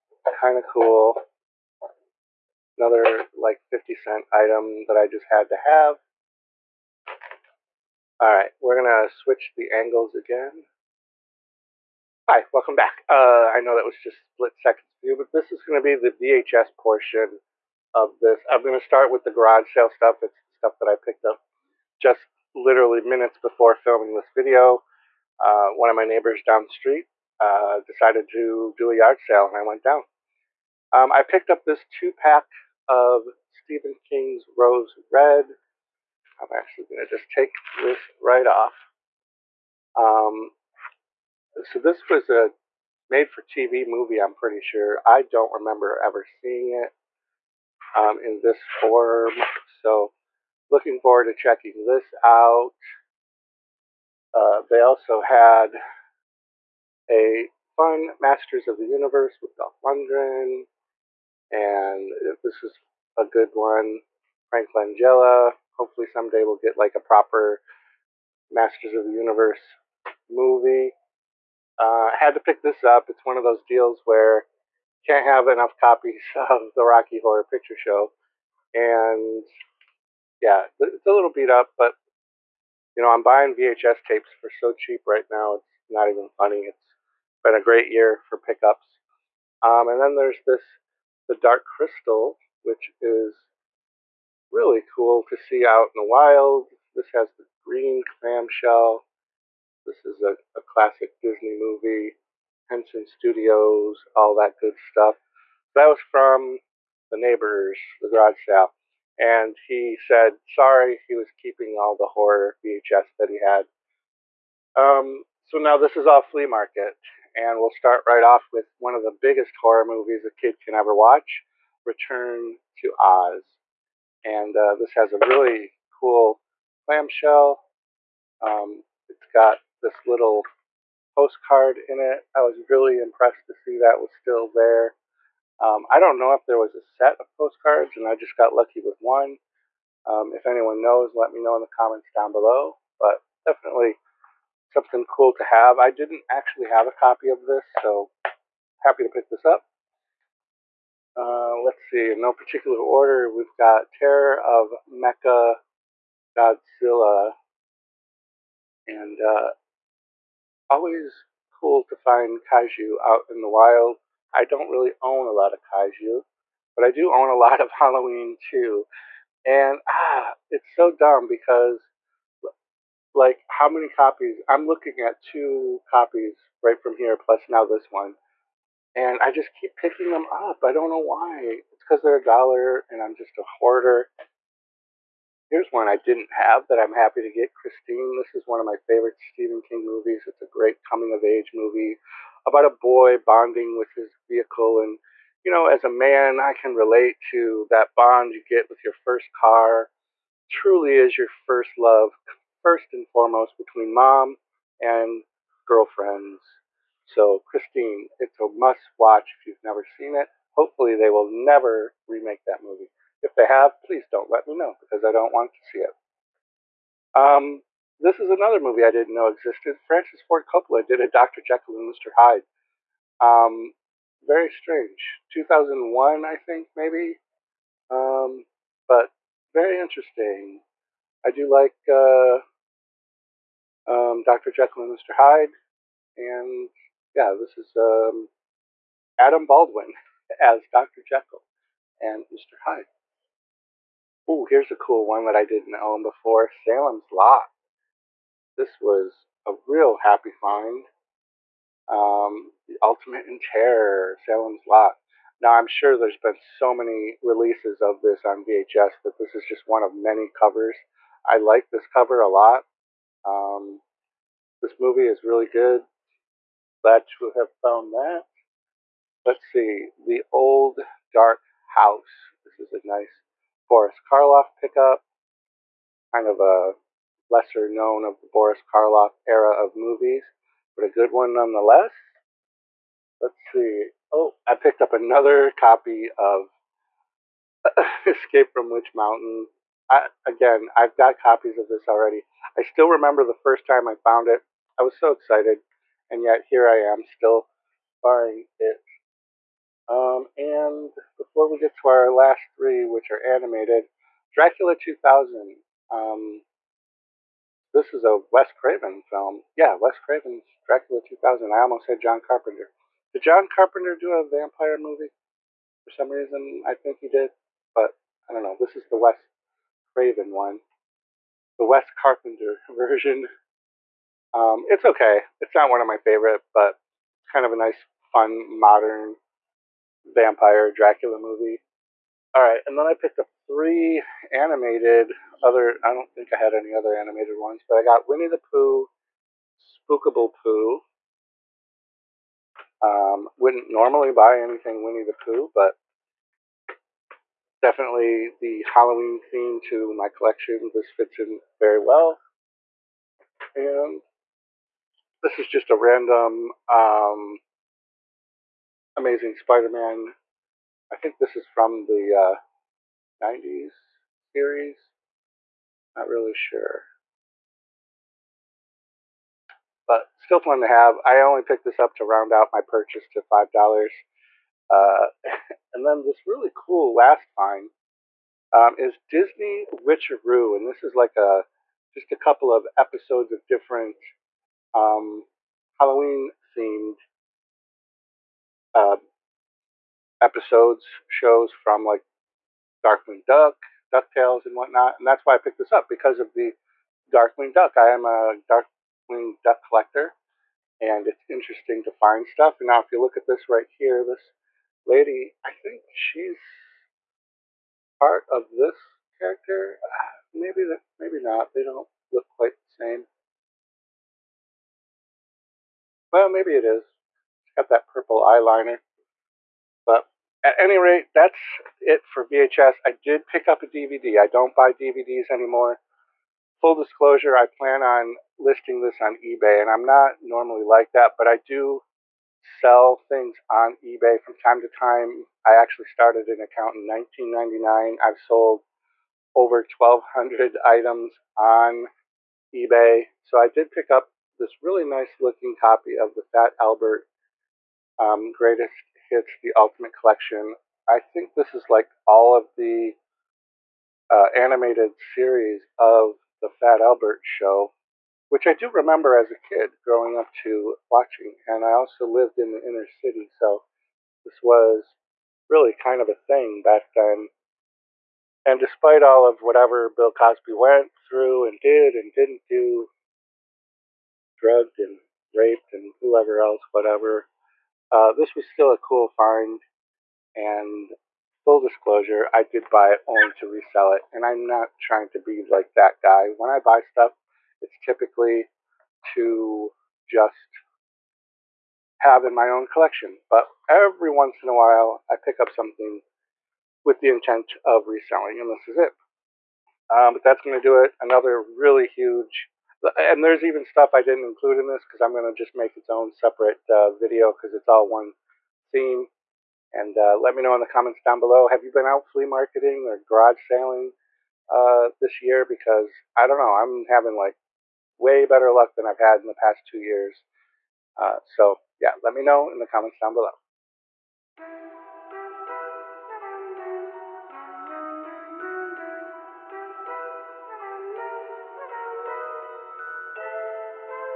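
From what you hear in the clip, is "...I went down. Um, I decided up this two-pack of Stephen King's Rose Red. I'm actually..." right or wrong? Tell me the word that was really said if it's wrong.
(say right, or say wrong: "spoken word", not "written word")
wrong: "picked", not "decided".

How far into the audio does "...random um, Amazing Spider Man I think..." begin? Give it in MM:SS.
05:55.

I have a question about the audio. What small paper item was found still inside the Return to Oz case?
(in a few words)
Postcard.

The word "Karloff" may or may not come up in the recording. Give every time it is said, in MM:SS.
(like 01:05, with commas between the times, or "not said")
04:34, 04:38.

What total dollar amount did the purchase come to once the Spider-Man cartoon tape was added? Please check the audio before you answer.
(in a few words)
$5.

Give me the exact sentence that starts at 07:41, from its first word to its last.
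And I also lived in the inner city, so this was really kind of a thing back then.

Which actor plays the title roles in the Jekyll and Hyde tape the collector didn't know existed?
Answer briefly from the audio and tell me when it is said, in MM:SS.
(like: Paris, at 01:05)
Adam Baldwin, at 03:59.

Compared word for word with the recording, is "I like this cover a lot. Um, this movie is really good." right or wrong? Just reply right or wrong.
right.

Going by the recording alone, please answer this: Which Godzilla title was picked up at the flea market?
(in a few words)
Terror of Mecha Godzilla.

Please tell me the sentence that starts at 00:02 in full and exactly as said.
Another like 50 cent item that I just had to have.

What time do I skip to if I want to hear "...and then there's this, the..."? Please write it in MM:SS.
01:29.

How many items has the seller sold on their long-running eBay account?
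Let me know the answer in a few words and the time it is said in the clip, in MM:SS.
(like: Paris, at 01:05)
Over 1,200, at 07:19.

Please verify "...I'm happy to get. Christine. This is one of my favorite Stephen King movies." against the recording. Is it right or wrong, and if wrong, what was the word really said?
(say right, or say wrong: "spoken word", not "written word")
right.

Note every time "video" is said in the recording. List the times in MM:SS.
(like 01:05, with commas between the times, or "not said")
00:24, 08:26.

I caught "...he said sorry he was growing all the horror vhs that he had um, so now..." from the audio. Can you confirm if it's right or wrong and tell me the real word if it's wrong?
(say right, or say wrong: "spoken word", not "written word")
wrong: "keeping", not "growing".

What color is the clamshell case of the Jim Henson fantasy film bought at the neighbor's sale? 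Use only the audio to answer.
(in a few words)
Green.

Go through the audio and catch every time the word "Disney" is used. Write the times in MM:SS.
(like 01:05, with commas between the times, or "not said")
01:41, 06:19.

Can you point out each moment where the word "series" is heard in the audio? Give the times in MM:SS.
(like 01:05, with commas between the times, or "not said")
06:04, 07:34.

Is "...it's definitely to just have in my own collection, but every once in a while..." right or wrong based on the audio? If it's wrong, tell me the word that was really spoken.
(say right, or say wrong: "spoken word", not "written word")
wrong: "typically", not "definitely".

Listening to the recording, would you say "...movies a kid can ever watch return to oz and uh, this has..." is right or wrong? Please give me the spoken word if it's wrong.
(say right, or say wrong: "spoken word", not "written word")
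right.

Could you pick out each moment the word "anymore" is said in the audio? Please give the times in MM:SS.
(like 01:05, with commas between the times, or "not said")
07:05.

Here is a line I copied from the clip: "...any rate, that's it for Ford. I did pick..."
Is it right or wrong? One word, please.
wrong.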